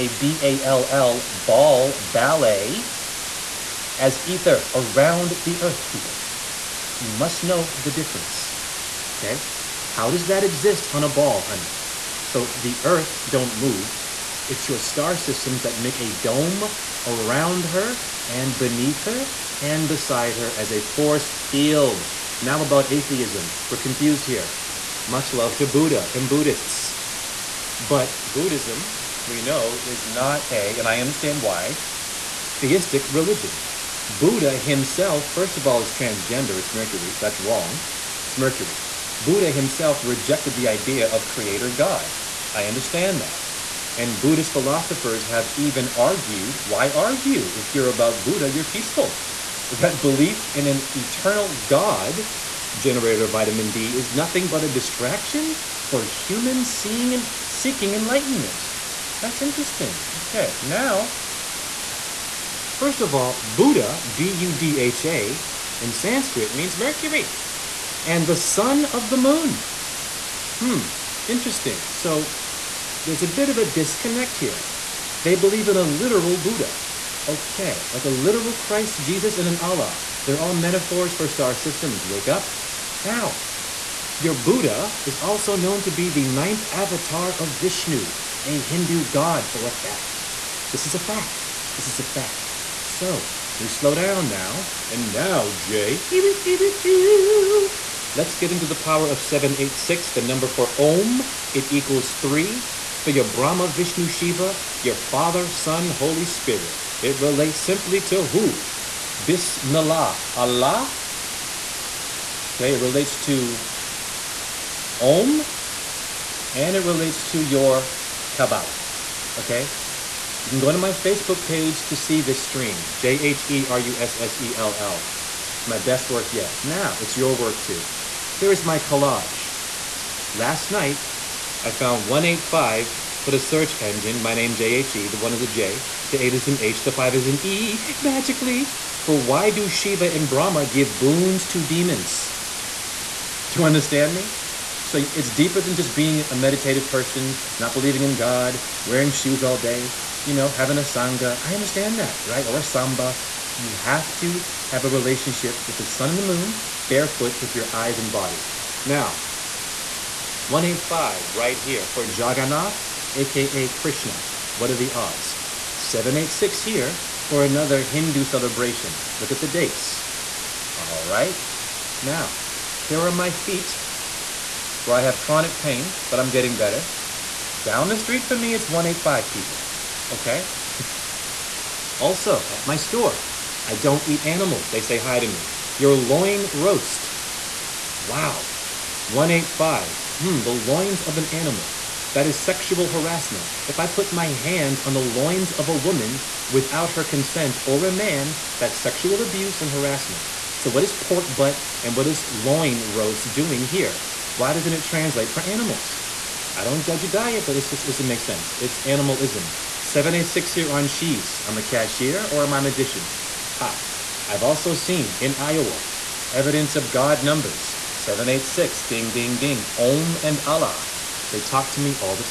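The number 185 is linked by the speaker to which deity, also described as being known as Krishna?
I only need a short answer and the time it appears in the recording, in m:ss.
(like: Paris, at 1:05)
Jagannath, at 2:42.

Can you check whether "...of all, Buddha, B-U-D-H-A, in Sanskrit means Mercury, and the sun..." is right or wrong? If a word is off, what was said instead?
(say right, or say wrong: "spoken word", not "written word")
right.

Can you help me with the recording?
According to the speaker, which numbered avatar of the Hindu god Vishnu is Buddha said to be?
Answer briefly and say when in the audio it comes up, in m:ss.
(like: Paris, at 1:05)
9th, at 1:26.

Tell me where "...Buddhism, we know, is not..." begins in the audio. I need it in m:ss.
0:28.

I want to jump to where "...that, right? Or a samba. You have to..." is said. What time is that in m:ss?
2:32.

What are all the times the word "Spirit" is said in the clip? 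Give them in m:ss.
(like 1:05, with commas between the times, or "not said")
1:46.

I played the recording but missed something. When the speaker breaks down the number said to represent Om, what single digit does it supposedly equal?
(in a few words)
3.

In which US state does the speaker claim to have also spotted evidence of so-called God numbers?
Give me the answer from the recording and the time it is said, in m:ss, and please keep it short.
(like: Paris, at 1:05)
Iowa, at 3:35.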